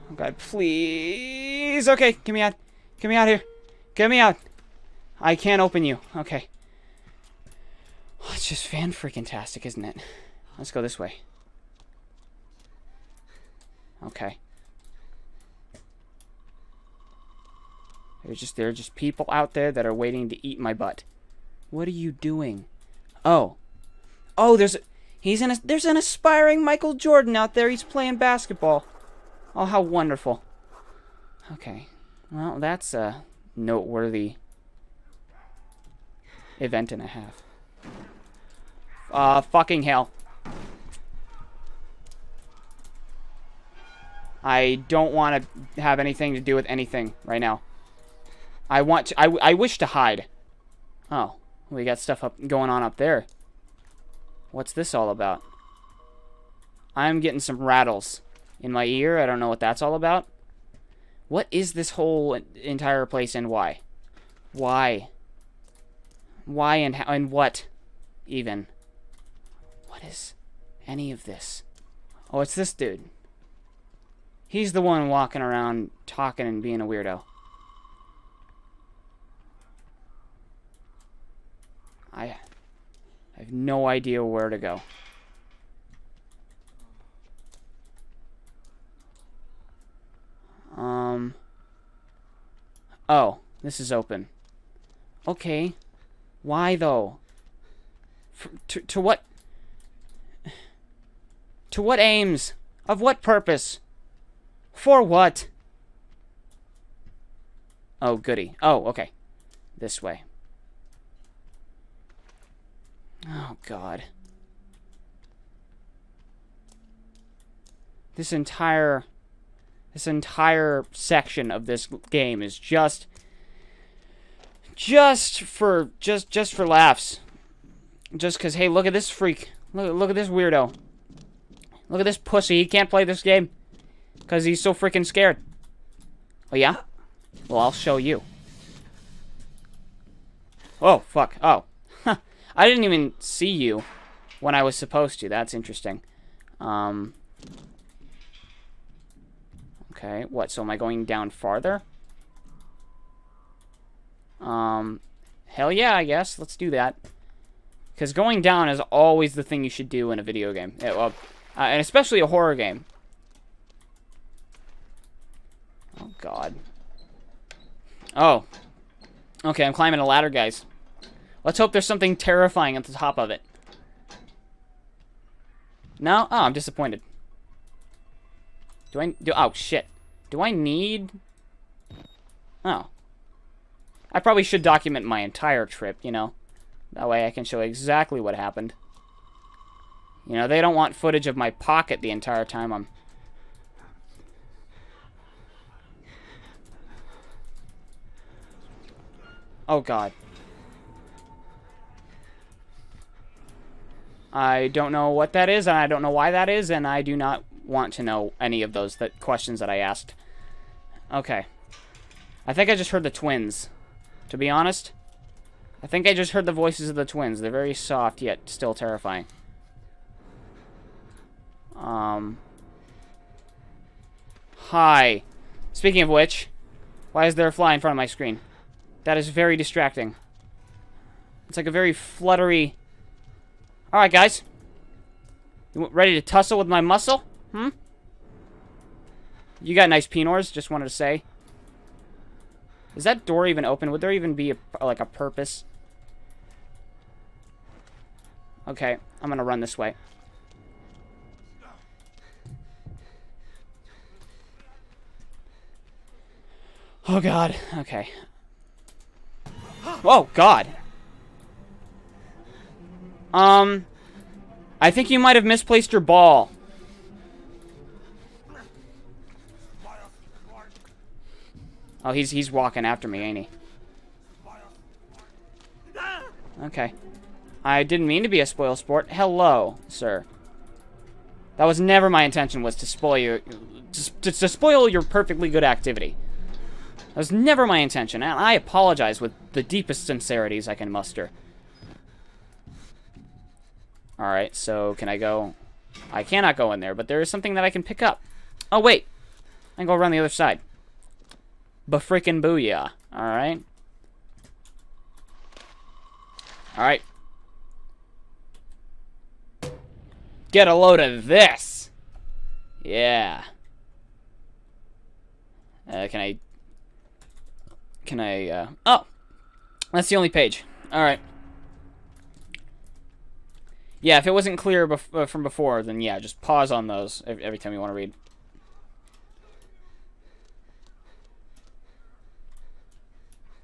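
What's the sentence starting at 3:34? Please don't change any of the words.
To be honest, I think I just heard the voices of the twins.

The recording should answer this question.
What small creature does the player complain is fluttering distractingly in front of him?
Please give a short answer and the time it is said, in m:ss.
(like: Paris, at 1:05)
a fly, at 3:47.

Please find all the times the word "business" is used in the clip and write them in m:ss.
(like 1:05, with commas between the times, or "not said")
not said.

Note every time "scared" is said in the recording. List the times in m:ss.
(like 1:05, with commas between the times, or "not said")
2:15.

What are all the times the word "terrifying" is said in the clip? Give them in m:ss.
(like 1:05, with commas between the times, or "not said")
2:52, 3:38.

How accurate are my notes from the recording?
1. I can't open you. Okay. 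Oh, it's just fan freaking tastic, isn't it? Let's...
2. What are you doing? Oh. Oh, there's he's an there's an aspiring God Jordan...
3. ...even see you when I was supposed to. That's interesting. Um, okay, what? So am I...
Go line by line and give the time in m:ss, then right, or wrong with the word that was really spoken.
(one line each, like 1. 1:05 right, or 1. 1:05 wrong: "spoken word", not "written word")
1. 0:05 right
2. 0:21 wrong: "Michael", not "God"
3. 2:22 right.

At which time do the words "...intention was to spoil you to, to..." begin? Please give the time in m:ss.
4:42.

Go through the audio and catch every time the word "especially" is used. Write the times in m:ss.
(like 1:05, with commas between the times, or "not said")
2:41.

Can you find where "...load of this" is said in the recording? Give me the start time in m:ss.
5:10.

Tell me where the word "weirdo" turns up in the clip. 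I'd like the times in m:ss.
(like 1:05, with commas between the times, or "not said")
1:16, 2:10.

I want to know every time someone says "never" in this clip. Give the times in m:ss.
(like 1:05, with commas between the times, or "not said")
4:41, 4:47.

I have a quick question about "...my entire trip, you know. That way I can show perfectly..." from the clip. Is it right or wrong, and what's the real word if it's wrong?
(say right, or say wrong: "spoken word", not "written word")
wrong: "exactly", not "perfectly".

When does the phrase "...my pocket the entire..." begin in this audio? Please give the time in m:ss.
3:11.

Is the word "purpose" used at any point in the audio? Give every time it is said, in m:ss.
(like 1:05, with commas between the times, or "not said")
1:43, 4:05.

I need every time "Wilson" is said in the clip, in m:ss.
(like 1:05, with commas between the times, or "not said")
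not said.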